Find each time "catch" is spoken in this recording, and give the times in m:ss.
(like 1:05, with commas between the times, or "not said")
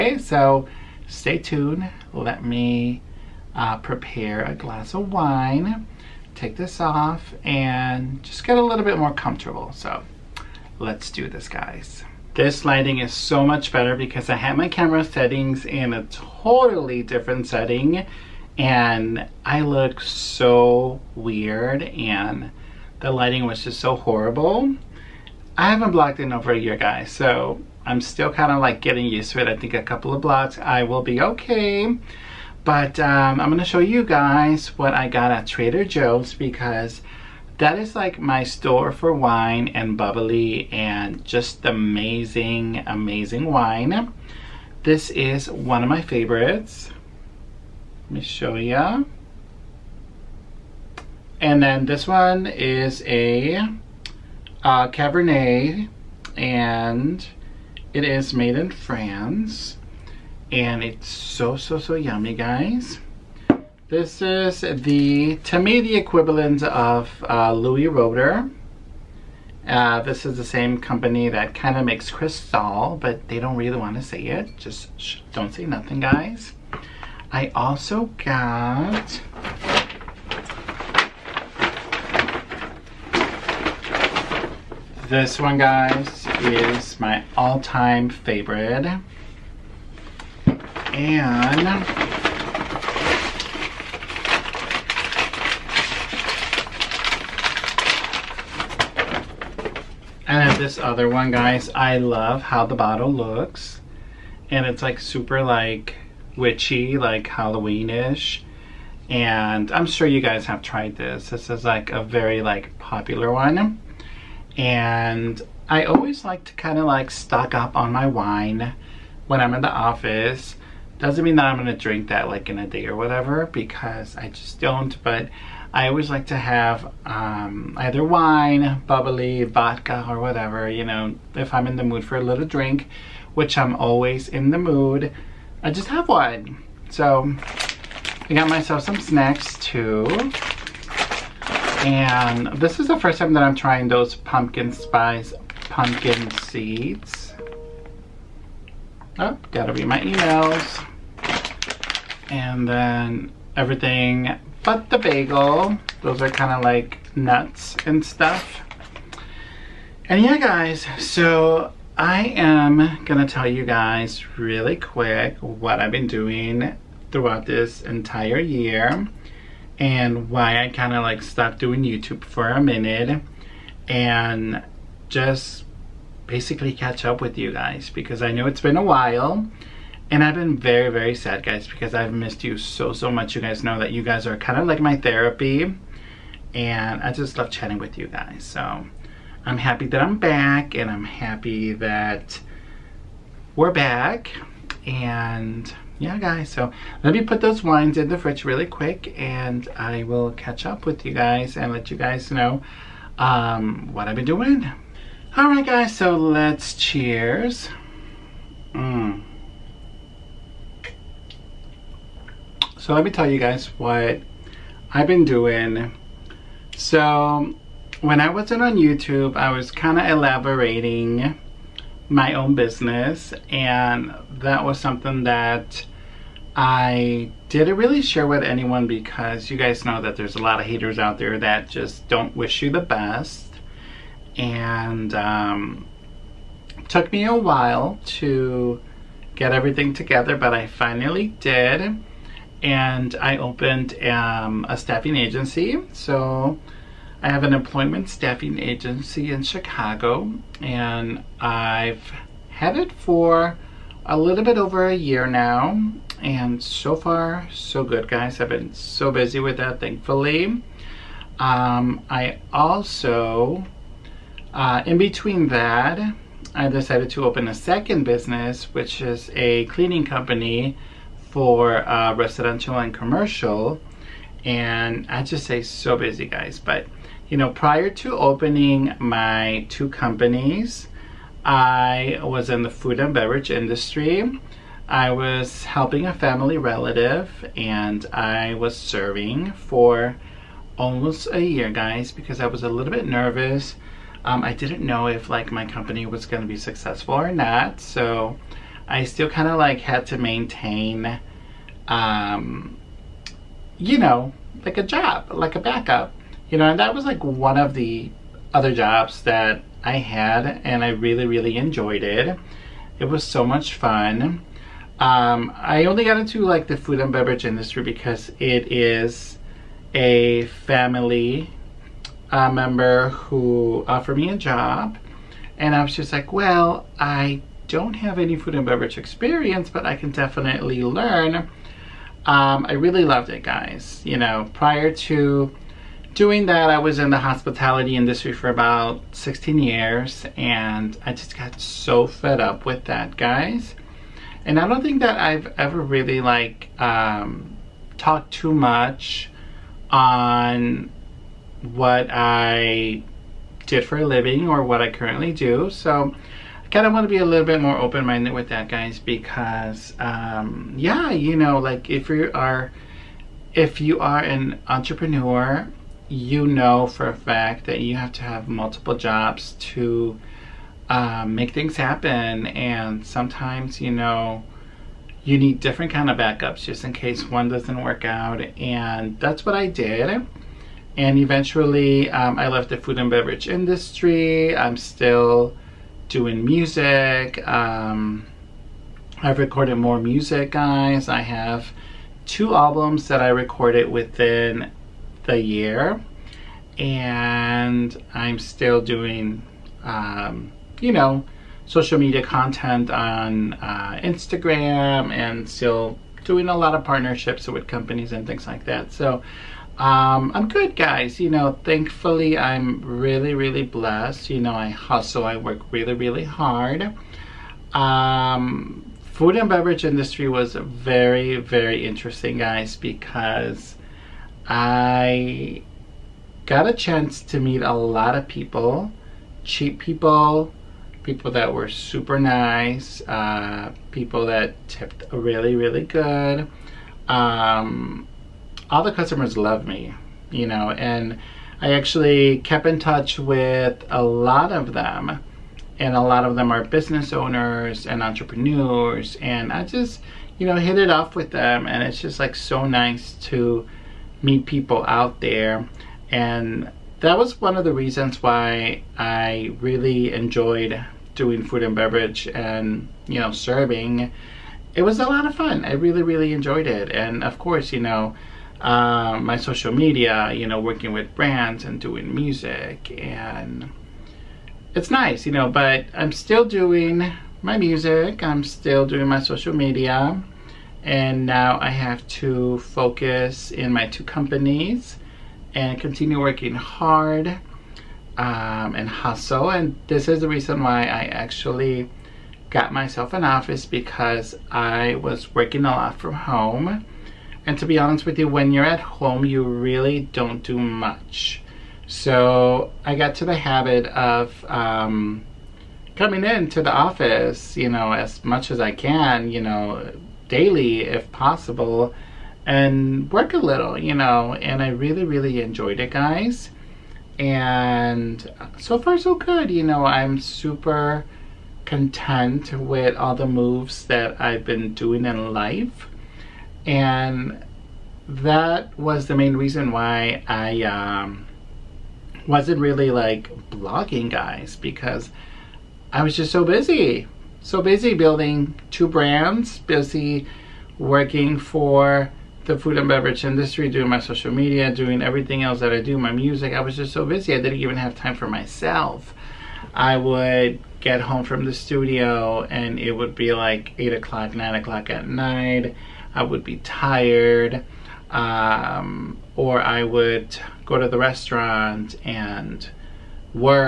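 2:56, 3:20.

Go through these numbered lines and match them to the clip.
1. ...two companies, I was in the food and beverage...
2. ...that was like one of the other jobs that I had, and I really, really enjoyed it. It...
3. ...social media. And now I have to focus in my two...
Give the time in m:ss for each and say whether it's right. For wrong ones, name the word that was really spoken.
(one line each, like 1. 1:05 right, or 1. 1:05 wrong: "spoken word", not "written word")
1. 4:39 right
2. 5:06 right
3. 7:59 right.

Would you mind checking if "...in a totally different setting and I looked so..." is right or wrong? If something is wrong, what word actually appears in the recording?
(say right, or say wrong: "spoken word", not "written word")
right.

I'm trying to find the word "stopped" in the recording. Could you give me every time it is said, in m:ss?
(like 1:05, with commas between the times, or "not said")
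2:51.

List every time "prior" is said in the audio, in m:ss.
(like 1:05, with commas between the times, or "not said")
4:37, 5:34.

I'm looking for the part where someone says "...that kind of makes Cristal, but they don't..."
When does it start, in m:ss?
1:11.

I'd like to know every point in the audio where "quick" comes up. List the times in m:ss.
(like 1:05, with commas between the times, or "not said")
2:44, 3:18.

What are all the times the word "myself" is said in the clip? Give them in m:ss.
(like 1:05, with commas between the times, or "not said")
2:18, 8:12, 9:08.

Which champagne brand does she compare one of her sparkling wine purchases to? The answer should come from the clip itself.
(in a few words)
Louis Roeder.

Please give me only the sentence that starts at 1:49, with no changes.
And I'm sure you guys have tried this.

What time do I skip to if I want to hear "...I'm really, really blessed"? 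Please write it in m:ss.
6:52.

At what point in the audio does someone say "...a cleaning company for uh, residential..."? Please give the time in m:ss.
4:29.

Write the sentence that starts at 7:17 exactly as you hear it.
Um, all the customers love me, you know, and I actually kept in touch with a lot of them.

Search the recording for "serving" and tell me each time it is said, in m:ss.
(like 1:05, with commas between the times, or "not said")
4:48, 7:43.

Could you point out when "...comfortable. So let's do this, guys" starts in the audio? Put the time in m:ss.
0:09.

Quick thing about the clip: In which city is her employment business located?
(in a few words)
Chicago.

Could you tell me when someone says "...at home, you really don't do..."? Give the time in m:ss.
8:18.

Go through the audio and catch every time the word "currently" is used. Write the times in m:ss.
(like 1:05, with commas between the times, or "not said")
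5:54.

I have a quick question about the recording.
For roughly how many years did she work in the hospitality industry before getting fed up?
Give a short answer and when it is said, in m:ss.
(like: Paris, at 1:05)
16, at 5:39.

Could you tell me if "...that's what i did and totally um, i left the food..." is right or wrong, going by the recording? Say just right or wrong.
wrong.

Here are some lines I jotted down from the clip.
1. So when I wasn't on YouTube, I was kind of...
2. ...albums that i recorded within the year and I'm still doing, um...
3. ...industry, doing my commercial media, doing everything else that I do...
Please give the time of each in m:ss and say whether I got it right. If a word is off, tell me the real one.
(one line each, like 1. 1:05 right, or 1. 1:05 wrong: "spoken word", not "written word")
1. 3:36 right
2. 6:32 right
3. 9:03 wrong: "social", not "commercial".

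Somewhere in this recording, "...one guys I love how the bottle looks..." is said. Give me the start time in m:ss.
1:41.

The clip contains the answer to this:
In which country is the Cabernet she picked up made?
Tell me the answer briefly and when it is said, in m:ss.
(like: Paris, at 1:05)
France, at 0:58.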